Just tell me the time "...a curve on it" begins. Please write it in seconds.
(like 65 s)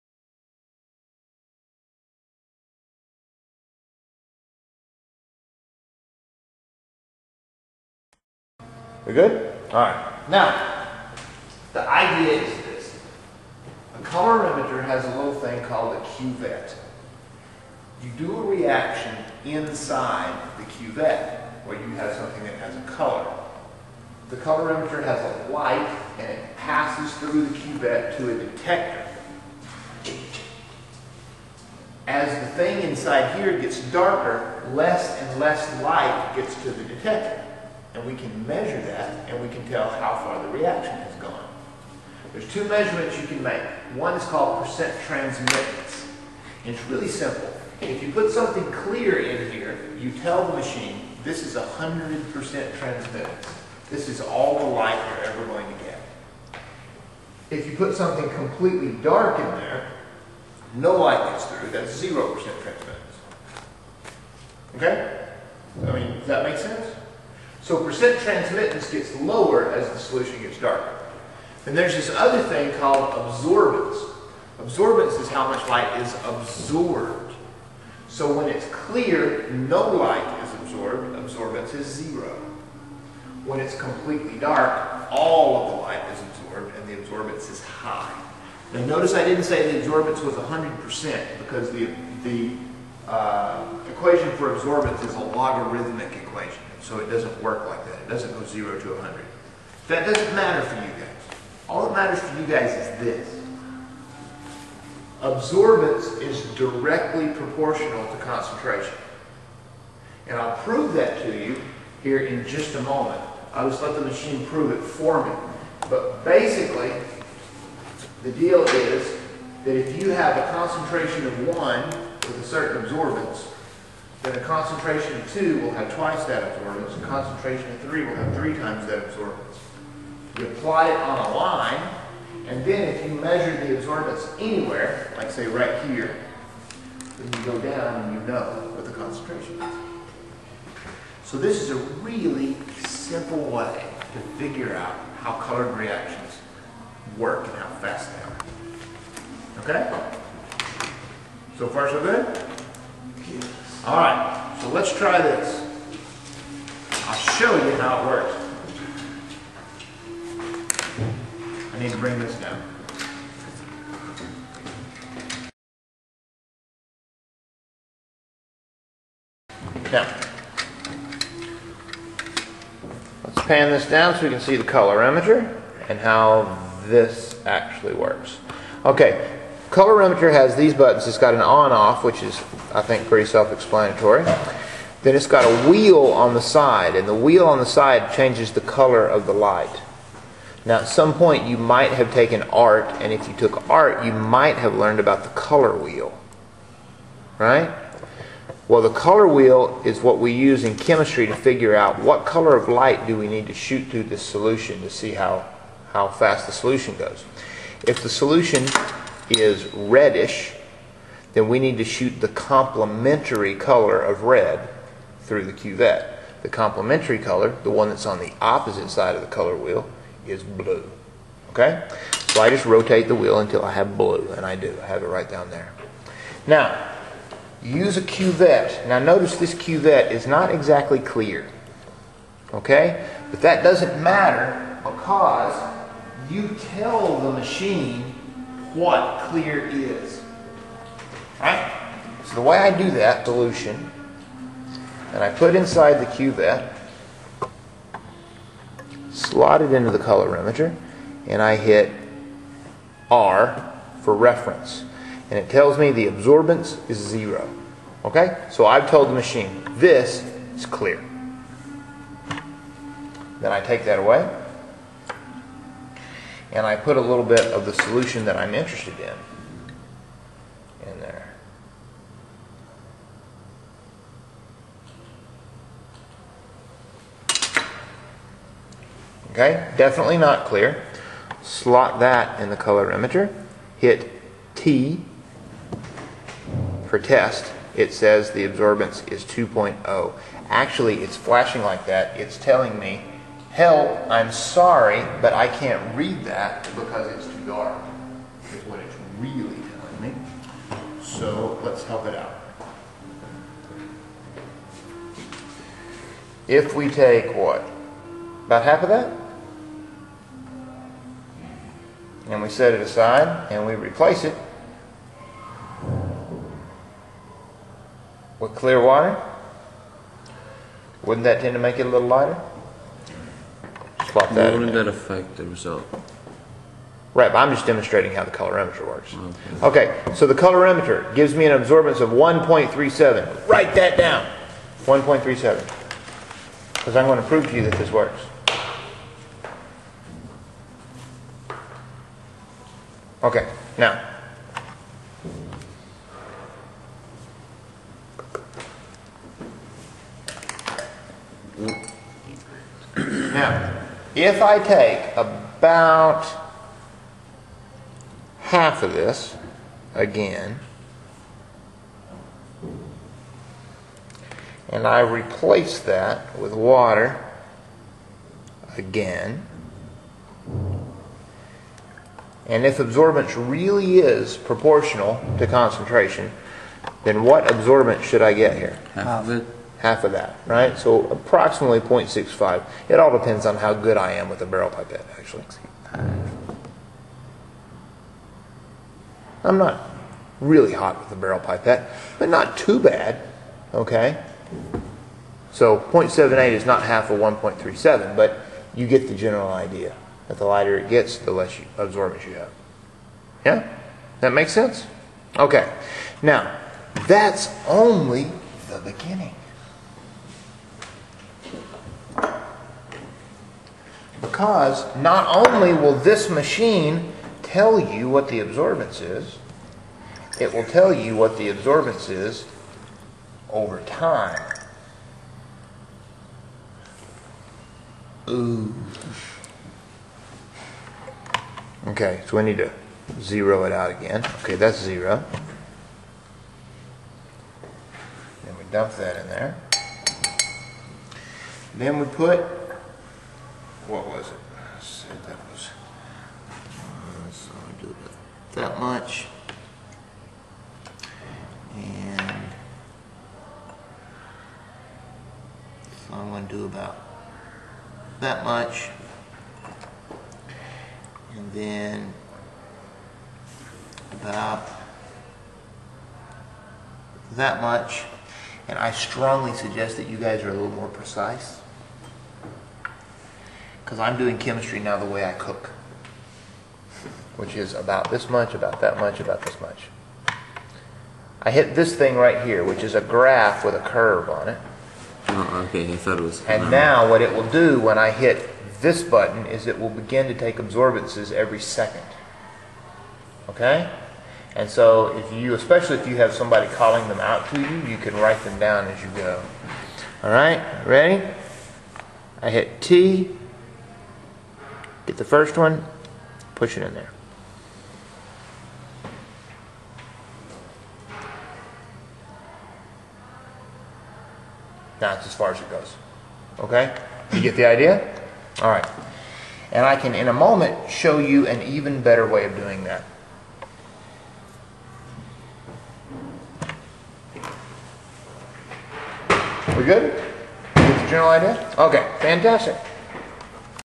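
483 s.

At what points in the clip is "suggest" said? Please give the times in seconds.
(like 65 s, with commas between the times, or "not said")
469 s.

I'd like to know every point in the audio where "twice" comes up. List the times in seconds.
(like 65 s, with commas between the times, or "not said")
125 s.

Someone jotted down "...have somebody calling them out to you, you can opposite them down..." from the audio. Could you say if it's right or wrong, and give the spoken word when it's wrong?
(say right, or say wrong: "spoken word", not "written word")
wrong: "write", not "opposite".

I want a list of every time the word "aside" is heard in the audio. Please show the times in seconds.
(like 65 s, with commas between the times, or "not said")
312 s.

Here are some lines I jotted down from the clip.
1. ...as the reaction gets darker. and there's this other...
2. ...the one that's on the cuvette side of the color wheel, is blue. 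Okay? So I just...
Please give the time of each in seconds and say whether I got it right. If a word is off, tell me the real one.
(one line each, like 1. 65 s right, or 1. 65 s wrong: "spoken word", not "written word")
1. 69 s wrong: "solution", not "reaction"
2. 217 s wrong: "opposite", not "cuvette".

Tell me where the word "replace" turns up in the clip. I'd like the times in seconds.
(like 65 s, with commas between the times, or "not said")
313 s, 364 s.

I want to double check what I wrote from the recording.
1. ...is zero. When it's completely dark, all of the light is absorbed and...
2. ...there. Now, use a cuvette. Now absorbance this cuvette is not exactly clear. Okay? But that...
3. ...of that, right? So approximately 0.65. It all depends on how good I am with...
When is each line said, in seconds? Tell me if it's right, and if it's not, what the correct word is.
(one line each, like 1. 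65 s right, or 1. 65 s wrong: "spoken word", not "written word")
1. 81 s right
2. 225 s wrong: "notice", not "absorbance"
3. 380 s right.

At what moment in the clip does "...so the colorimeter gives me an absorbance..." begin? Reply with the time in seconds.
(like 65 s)
330 s.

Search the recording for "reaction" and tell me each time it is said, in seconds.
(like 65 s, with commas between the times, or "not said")
18 s, 40 s, 145 s.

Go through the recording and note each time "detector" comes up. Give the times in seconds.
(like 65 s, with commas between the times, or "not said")
28 s, 36 s.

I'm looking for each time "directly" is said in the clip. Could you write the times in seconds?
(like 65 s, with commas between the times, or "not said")
106 s.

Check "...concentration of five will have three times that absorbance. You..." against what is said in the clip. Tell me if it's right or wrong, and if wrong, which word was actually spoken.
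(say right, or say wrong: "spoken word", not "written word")
wrong: "three", not "five".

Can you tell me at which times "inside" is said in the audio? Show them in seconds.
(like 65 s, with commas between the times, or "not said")
19 s, 32 s, 245 s.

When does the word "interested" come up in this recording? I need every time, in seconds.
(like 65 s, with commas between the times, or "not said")
268 s.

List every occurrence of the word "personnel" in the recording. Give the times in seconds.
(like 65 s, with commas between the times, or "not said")
not said.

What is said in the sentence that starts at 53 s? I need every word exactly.
This is all the light you're ever going to get.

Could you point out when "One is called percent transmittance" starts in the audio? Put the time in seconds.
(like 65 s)
43 s.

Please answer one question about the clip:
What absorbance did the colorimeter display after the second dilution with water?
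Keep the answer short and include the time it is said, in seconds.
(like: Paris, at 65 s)
0.78, at 395 s.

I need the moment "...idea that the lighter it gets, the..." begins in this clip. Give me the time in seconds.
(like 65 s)
399 s.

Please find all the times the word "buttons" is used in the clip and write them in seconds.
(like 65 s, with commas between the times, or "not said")
180 s, 489 s.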